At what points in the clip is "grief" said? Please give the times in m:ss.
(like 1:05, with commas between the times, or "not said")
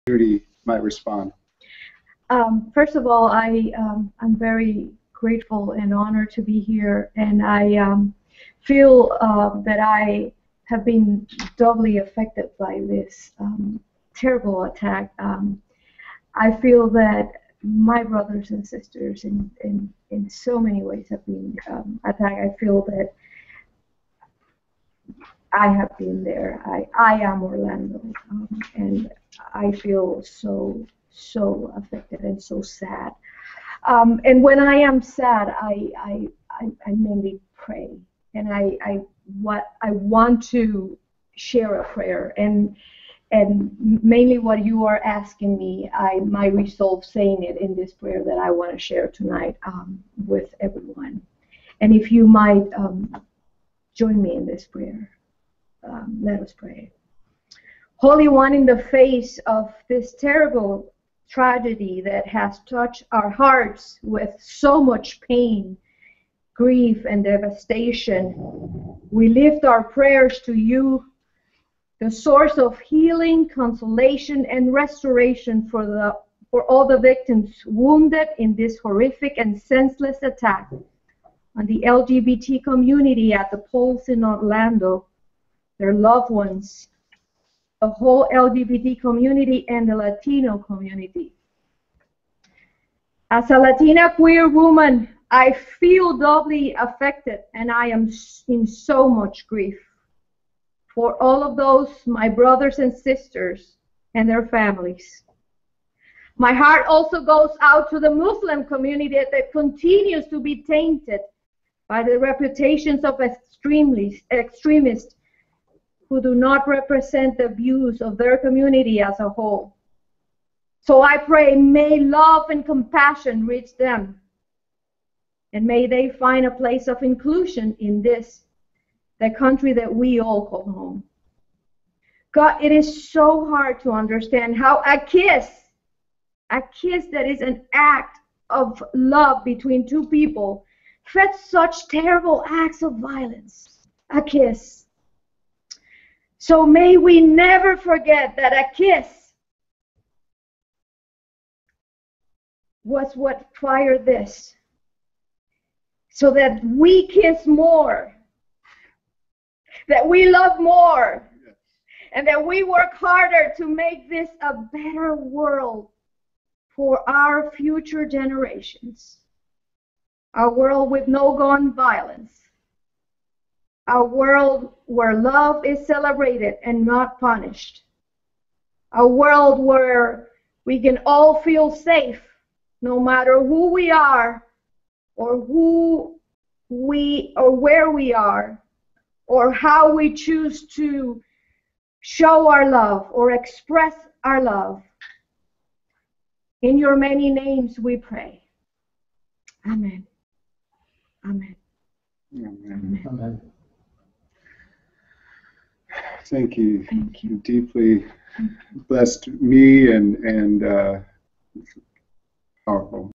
1:06, 1:39.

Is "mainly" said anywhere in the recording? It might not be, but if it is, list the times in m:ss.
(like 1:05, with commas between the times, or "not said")
0:36, 0:44.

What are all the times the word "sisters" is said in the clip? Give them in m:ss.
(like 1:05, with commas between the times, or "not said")
0:18, 1:42.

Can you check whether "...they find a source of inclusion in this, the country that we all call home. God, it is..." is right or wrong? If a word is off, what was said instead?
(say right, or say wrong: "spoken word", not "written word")
wrong: "place", not "source".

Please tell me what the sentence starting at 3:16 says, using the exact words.
In your many names we pray.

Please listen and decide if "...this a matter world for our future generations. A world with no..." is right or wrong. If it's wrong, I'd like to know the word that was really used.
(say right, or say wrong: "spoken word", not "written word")
wrong: "better", not "matter".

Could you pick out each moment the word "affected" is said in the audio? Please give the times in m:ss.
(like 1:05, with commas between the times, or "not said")
0:11, 0:31, 1:36.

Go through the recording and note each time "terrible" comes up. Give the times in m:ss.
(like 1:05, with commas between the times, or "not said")
0:14, 1:00, 2:21.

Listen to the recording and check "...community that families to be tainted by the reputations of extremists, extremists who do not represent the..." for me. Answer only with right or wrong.
wrong.